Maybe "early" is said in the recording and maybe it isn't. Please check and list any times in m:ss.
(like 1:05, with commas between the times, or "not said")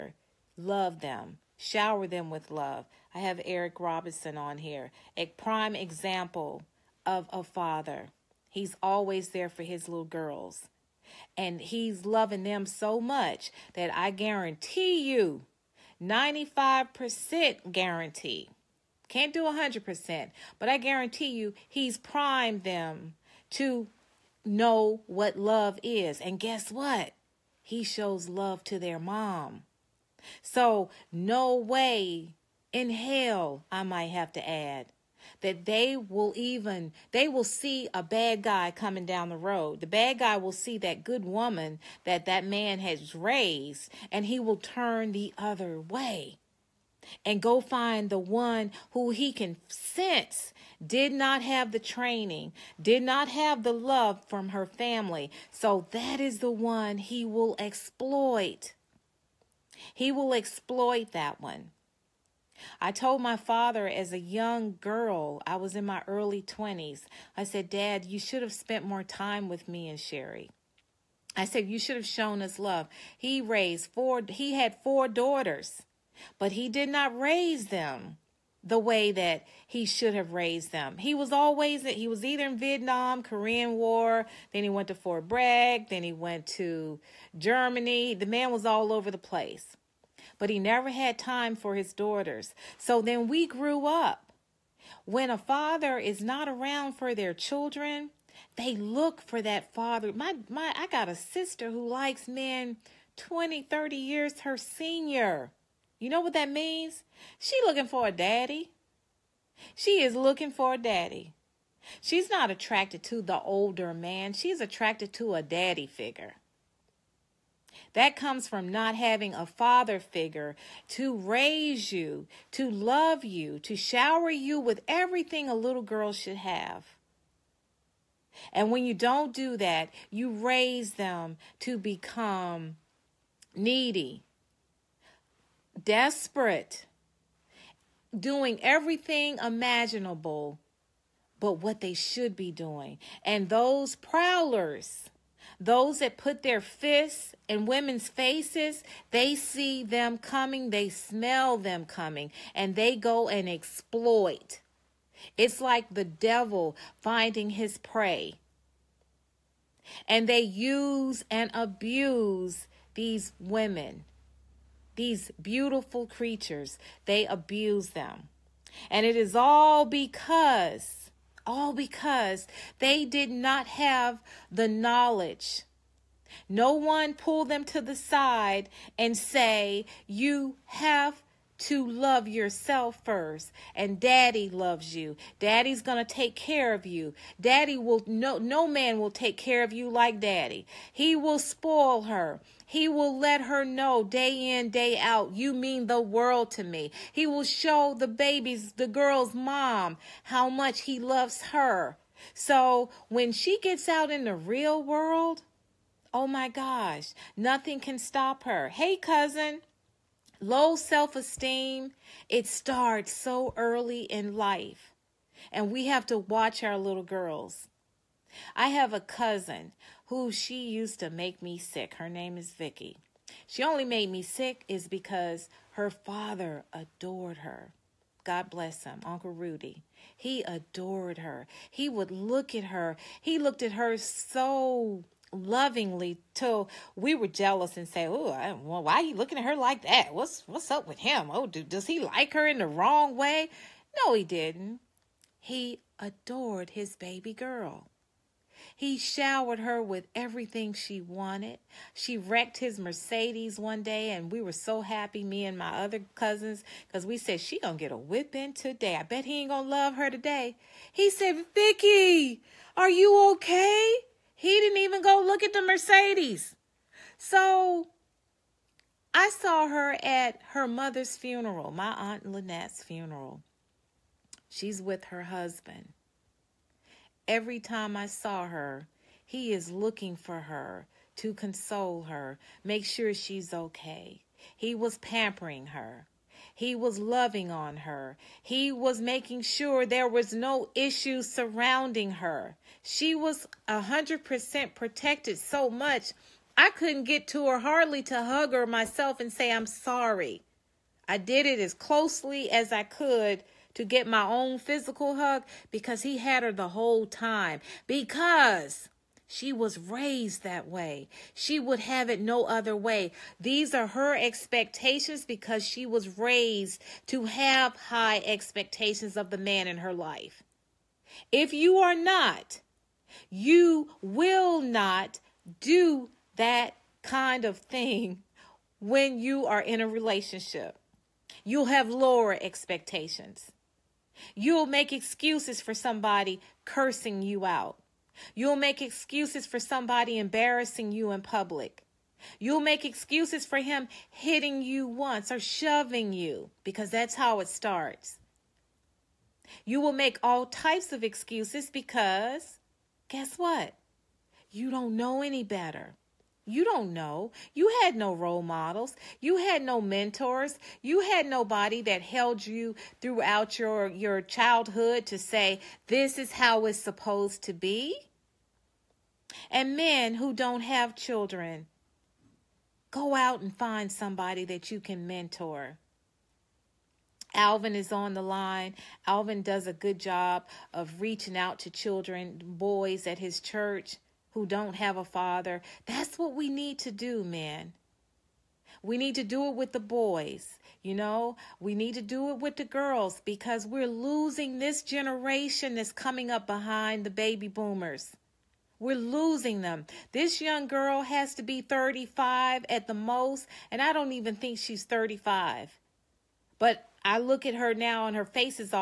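1:06, 3:33.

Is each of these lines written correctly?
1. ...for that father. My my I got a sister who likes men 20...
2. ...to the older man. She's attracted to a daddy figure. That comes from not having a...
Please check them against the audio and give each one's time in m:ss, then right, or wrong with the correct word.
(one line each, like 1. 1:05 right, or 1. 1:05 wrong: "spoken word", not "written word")
1. 1:39 right
2. 1:53 right.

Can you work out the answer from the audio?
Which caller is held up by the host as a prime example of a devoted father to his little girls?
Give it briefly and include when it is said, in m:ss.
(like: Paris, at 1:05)
Eric Robinson, at 0:03.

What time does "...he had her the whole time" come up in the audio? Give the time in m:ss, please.
5:06.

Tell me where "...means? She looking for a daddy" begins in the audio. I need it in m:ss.
1:46.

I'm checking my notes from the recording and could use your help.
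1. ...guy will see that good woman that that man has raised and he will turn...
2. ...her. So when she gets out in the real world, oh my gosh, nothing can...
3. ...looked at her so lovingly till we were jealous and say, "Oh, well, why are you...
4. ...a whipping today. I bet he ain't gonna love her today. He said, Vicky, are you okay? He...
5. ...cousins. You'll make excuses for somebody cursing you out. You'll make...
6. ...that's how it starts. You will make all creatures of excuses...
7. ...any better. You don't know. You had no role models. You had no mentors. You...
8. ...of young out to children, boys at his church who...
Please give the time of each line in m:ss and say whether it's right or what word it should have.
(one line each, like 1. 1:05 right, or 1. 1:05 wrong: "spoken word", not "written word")
1. 0:40 right
2. 3:21 right
3. 3:53 right
4. 4:17 right
5. 5:32 wrong: "expectations", not "cousins"
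6. 5:46 wrong: "types", not "creatures"
7. 5:55 right
8. 6:20 wrong: "reaching", not "young".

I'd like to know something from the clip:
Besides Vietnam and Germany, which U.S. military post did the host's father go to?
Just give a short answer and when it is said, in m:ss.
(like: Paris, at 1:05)
Fort Bragg, at 1:24.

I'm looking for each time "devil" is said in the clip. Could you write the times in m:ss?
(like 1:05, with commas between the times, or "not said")
2:36.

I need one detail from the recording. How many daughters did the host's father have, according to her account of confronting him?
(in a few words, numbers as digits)
4.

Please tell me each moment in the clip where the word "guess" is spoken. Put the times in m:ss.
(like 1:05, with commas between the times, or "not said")
0:26, 5:53.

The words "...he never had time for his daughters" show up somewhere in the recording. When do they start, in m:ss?
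1:30.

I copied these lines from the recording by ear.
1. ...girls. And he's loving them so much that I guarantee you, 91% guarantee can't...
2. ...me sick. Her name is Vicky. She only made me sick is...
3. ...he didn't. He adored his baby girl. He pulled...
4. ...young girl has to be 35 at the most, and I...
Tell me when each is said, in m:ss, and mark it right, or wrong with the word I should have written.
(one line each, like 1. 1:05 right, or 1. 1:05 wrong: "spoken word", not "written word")
1. 0:10 wrong: "95", not "91"
2. 3:41 right
3. 4:04 wrong: "showered", not "pulled"
4. 6:40 right.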